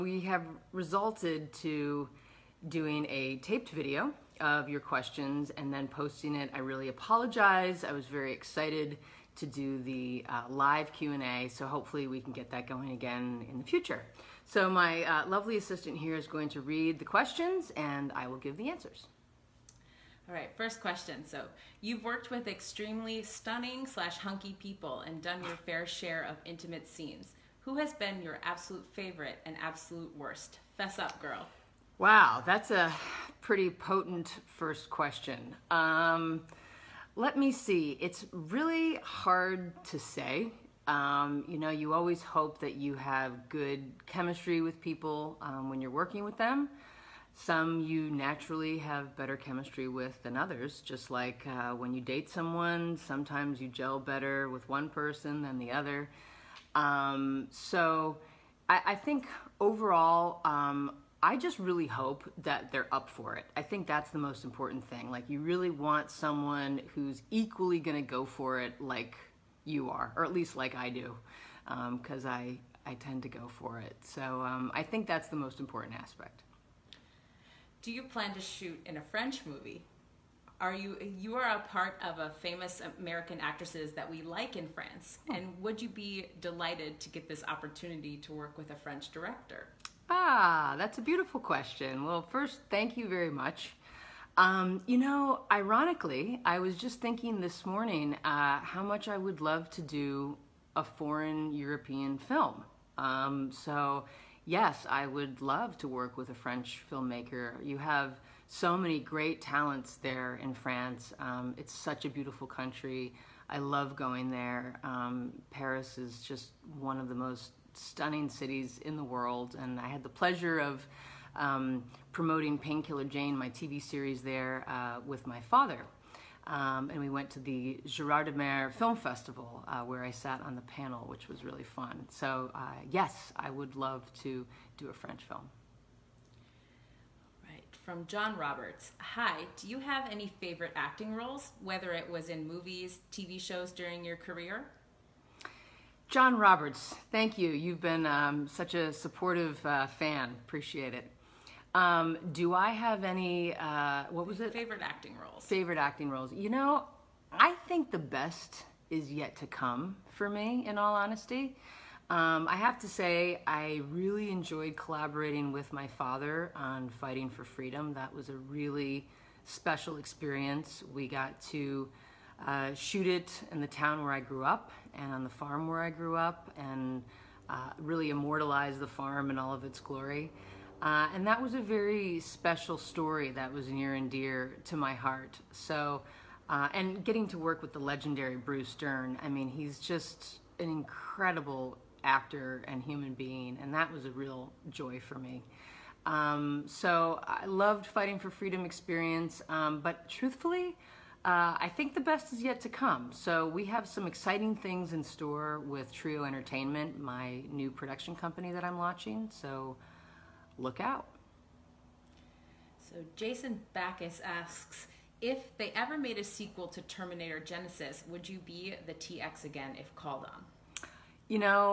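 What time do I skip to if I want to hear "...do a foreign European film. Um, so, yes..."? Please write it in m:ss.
1:39.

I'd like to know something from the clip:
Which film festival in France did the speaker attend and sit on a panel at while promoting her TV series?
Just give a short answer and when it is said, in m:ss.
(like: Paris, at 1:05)
Gérardmer Film Festival, at 2:07.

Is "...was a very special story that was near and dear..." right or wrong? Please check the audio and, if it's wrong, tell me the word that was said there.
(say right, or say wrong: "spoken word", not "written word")
right.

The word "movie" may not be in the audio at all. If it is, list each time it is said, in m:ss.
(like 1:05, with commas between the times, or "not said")
1:19, 2:22.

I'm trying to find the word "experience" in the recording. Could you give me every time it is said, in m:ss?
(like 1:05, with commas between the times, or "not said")
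2:49, 3:18.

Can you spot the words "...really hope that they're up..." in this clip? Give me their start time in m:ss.
1:01.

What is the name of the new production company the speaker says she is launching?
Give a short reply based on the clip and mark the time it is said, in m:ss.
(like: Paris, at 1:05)
Trio Entertainment, at 3:25.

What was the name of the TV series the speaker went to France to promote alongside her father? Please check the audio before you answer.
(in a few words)
Painkiller Jane.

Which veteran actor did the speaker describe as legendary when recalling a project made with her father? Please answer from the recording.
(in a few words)
Bruce Dern.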